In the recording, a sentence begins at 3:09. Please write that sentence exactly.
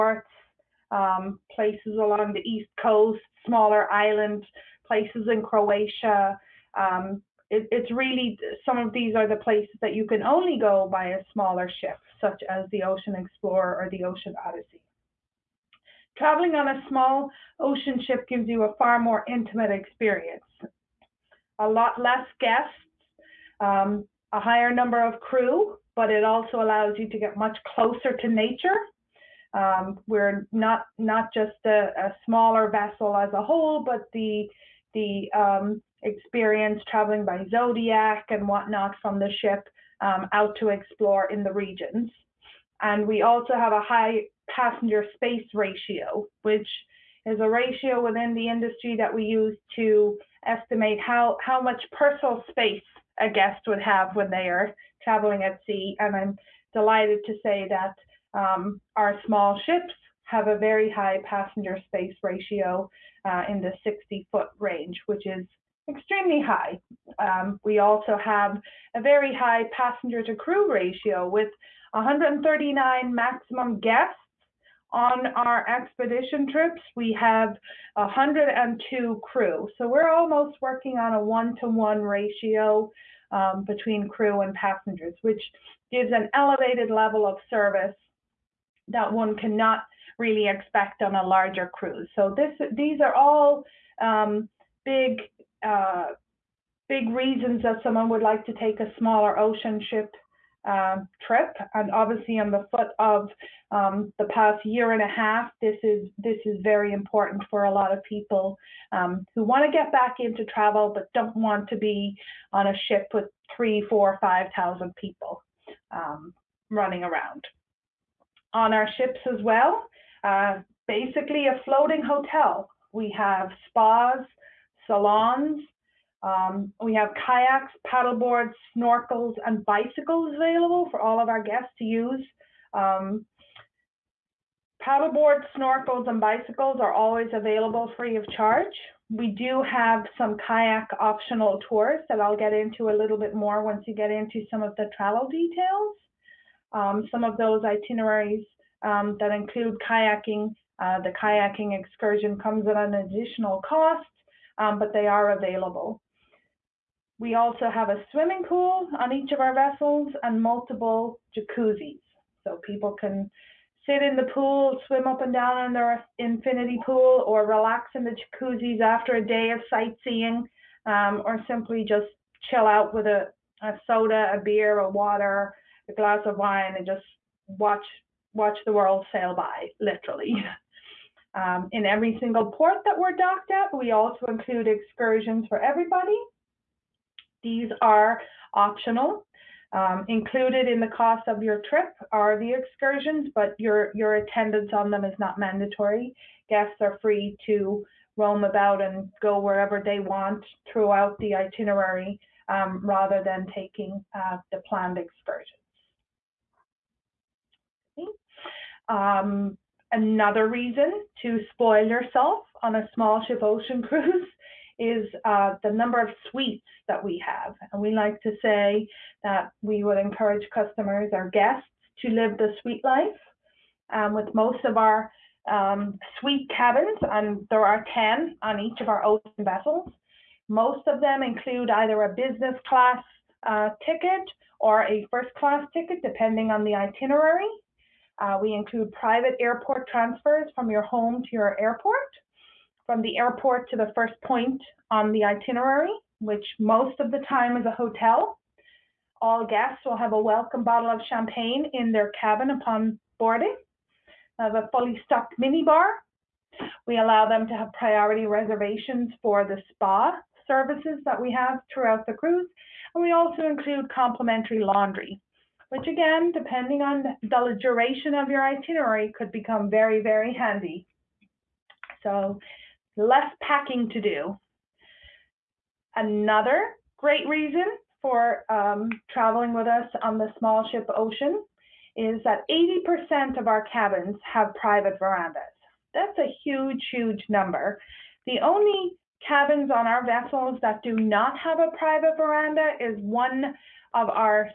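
Um, included in the cost of your trip are the excursions, but your, your attendance on them is not mandatory.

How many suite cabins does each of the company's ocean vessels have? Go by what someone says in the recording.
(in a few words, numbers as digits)
10.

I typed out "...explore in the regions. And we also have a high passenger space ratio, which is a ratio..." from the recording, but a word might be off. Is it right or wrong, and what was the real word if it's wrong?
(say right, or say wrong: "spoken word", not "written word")
right.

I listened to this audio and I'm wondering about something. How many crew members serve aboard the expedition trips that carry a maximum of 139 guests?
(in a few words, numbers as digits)
102.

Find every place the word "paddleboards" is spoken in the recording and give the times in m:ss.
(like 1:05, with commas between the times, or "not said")
2:07, 2:14.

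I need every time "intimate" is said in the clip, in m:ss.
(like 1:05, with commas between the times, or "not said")
0:19.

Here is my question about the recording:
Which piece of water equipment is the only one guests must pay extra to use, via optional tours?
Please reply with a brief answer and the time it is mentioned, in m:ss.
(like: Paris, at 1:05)
Kayaks, at 2:31.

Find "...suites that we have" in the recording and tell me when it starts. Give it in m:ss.
3:36.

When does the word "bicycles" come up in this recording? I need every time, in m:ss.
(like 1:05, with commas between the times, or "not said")
2:09, 2:16.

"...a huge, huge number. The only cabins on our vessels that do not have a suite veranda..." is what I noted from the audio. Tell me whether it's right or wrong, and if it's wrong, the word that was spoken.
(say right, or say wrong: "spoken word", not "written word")
wrong: "private", not "suite".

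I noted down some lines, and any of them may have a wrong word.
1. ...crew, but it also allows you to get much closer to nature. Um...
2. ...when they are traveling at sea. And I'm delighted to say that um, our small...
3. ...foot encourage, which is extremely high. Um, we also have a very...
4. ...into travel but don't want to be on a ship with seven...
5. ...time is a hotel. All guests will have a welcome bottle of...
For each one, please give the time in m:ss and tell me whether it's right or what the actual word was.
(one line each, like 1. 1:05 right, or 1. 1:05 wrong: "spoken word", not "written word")
1. 0:25 right
2. 0:54 right
3. 1:04 wrong: "range", not "encourage"
4. 1:50 wrong: "three", not "seven"
5. 4:07 right.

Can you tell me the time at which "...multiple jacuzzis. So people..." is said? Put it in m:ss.
2:40.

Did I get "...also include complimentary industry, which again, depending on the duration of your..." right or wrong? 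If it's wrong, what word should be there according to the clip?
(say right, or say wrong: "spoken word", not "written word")
wrong: "laundry", not "industry".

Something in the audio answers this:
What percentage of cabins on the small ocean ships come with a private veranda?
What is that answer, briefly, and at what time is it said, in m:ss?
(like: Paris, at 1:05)
80%, at 4:42.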